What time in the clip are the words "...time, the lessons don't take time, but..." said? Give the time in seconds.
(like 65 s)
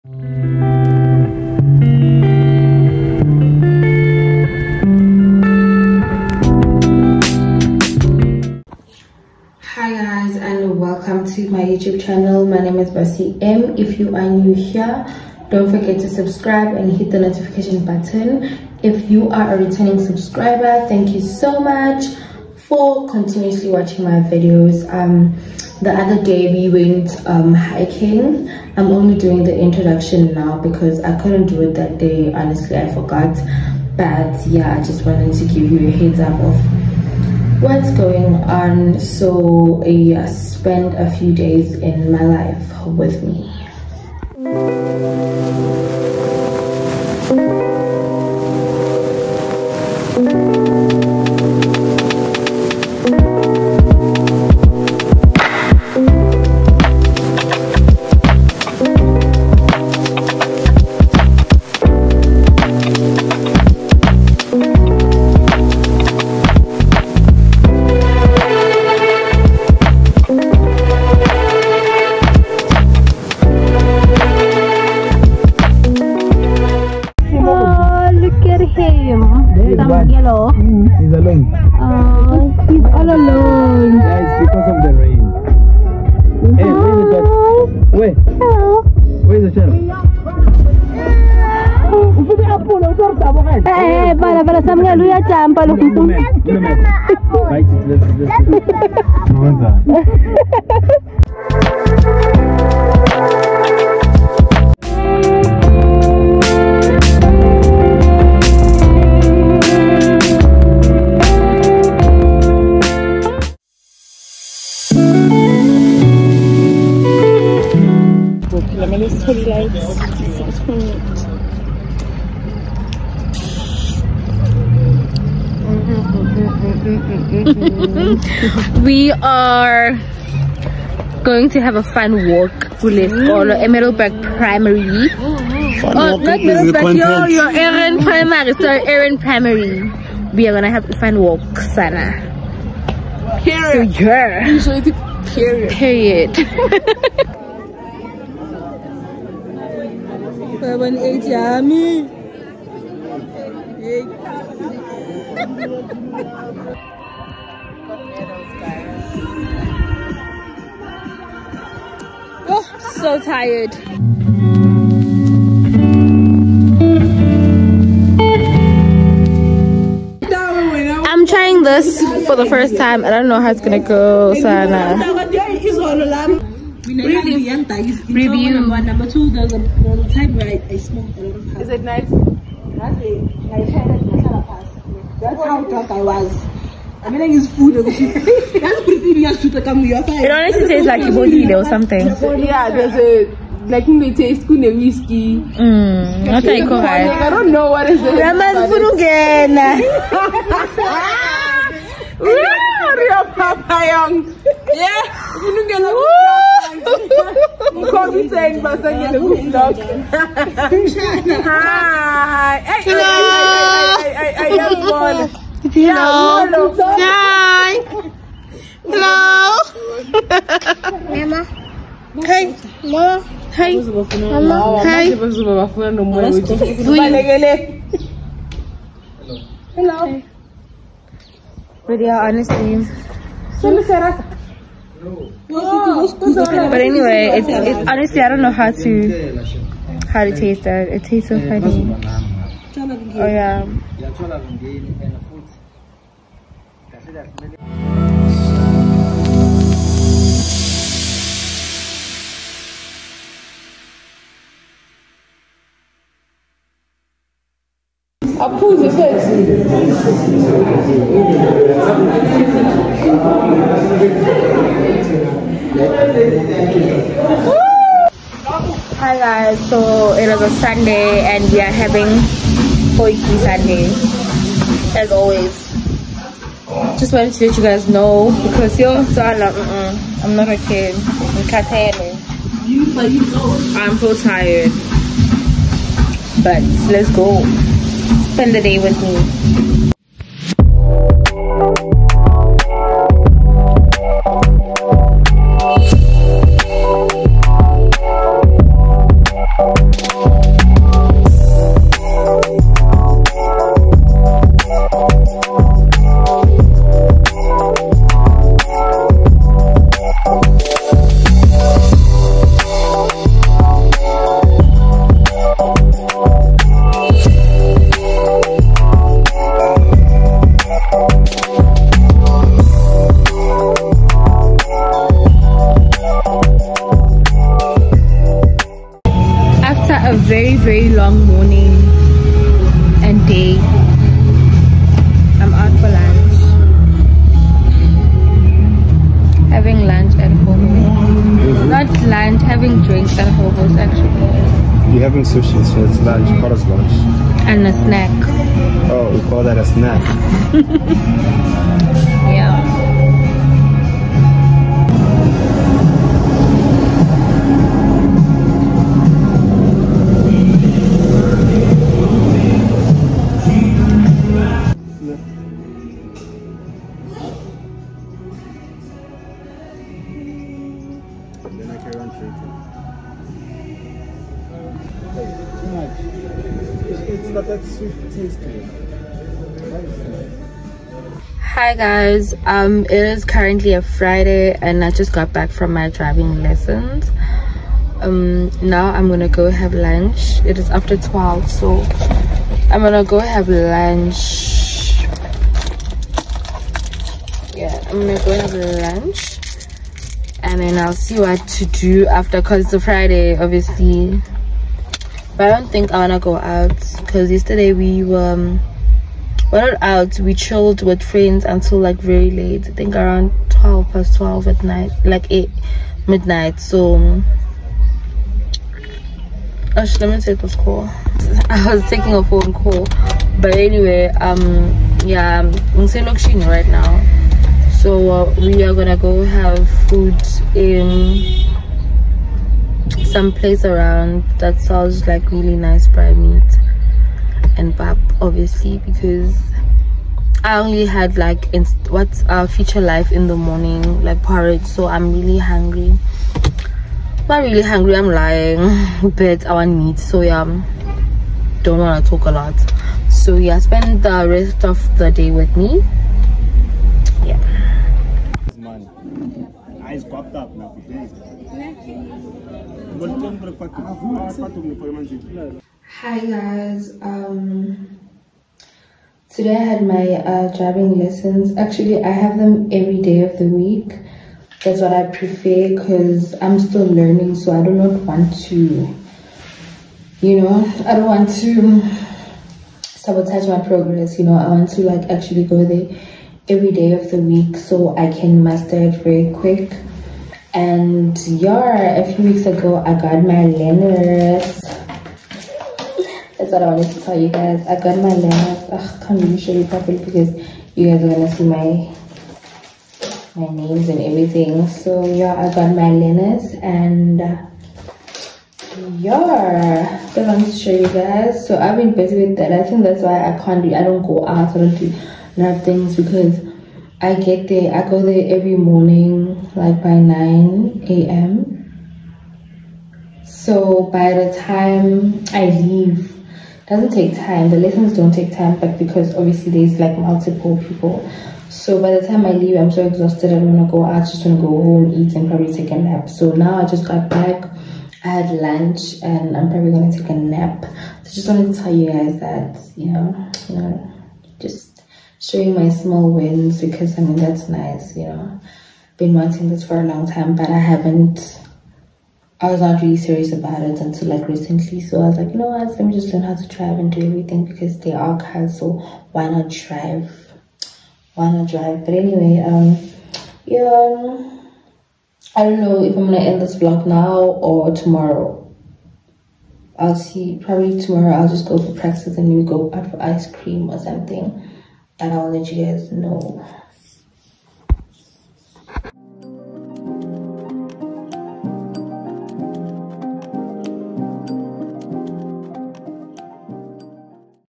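527 s.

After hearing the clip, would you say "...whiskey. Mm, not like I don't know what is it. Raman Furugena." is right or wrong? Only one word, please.
right.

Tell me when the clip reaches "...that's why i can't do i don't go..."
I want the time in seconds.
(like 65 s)
512 s.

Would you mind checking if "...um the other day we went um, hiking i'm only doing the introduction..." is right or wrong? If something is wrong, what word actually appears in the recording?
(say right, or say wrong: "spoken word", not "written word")
right.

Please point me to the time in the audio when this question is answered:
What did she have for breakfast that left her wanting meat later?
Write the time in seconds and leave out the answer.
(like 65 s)
444 s.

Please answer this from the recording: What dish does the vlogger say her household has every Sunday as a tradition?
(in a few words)
Potjie.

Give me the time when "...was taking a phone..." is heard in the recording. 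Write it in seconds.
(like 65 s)
421 s.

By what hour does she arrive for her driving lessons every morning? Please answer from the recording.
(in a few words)
9 a.m.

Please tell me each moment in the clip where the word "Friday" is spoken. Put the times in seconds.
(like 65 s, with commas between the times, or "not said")
383 s, 402 s.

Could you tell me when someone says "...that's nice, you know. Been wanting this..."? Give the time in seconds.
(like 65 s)
547 s.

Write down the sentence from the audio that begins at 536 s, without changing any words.
So now I just got back, I had lunch, and I'm probably gonna take a nap.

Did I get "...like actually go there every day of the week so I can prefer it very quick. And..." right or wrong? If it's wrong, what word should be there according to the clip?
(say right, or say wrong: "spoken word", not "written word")
wrong: "master", not "prefer".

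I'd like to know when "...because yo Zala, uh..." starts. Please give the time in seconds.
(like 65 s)
278 s.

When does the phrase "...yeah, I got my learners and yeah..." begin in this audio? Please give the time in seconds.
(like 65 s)
505 s.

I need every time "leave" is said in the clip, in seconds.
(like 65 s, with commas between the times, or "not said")
525 s, 532 s.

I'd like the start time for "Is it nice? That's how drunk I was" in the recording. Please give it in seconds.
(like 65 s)
181 s.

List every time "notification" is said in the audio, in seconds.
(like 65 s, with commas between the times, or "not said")
17 s.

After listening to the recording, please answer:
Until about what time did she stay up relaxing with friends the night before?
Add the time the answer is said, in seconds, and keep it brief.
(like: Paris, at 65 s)
12 past 12, at 413 s.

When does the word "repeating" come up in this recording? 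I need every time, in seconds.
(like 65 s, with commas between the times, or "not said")
not said.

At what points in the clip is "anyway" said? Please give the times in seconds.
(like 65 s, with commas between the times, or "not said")
236 s, 423 s, 561 s.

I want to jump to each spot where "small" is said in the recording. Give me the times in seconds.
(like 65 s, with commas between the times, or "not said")
545 s.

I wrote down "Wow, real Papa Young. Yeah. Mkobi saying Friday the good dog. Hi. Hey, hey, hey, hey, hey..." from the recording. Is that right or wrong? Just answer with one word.
wrong.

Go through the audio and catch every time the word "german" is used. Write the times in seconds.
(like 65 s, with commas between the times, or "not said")
not said.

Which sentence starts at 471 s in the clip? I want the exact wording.
Actually, I have them every day of the week.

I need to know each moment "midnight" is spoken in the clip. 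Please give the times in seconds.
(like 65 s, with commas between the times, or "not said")
416 s.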